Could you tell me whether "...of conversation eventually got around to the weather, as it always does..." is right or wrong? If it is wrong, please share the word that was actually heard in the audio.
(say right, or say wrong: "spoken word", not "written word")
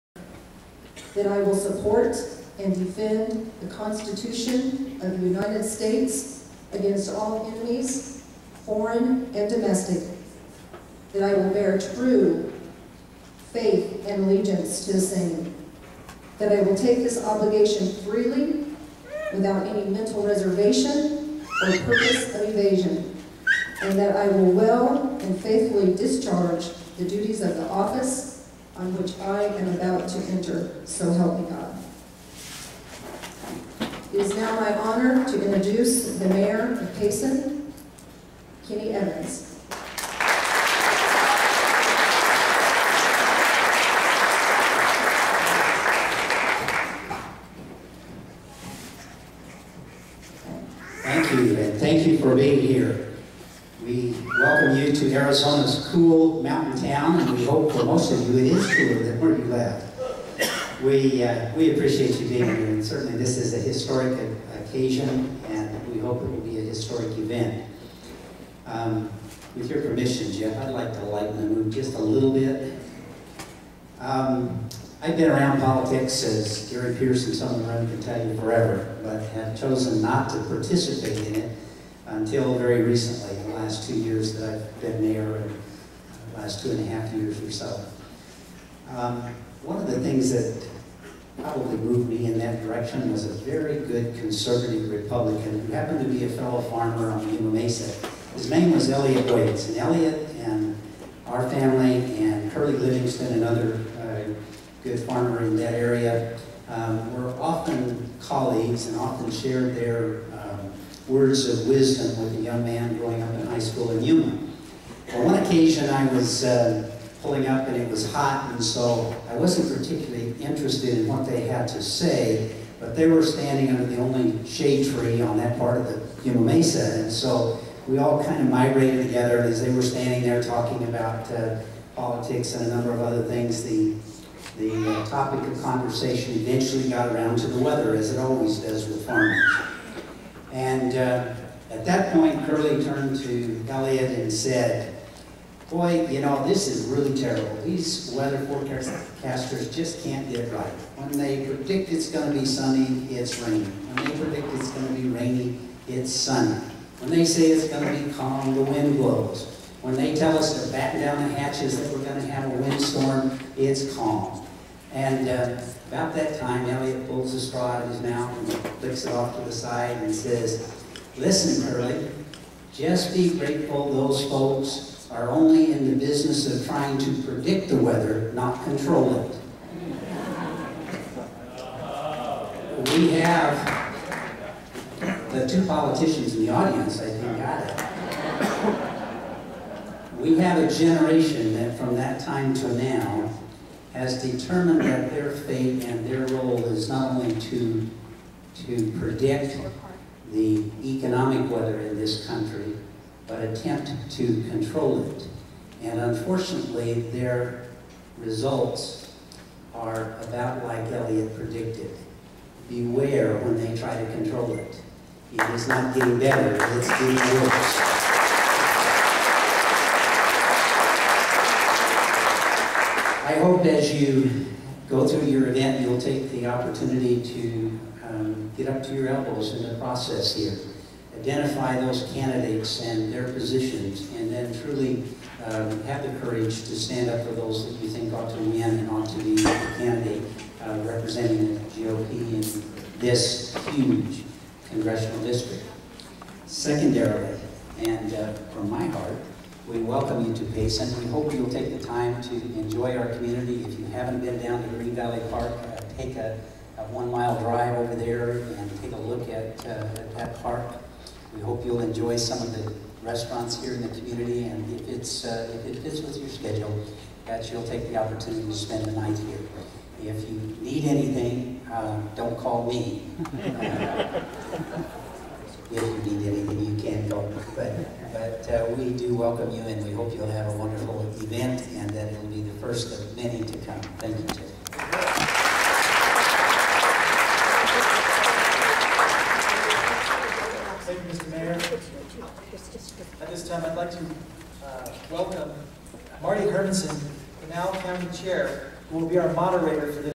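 right.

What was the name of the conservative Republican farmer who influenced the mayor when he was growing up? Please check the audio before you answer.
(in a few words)
Elliot Waits.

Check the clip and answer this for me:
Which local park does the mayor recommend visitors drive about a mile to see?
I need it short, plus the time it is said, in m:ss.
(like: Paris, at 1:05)
Green Valley Park, at 4:14.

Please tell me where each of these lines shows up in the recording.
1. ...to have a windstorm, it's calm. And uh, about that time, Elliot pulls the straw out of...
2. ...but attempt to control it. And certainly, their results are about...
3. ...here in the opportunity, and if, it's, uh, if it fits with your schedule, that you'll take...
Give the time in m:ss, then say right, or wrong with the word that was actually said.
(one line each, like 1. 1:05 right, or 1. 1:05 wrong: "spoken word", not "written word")
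1. 2:42 right
2. 3:23 wrong: "unfortunately", not "certainly"
3. 4:23 wrong: "community", not "opportunity".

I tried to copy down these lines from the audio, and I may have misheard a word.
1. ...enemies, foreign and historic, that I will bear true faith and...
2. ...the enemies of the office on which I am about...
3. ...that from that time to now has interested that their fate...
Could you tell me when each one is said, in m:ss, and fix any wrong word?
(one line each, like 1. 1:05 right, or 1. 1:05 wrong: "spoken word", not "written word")
1. 0:07 wrong: "domestic", not "historic"
2. 0:26 wrong: "duties", not "enemies"
3. 3:11 wrong: "determined", not "interested".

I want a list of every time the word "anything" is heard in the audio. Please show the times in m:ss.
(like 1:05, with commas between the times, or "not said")
4:30, 4:36.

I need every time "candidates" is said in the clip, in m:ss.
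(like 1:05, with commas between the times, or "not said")
3:52, 3:59.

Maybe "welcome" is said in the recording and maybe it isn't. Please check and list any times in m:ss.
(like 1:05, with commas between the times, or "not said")
0:54, 4:09, 4:39, 4:55.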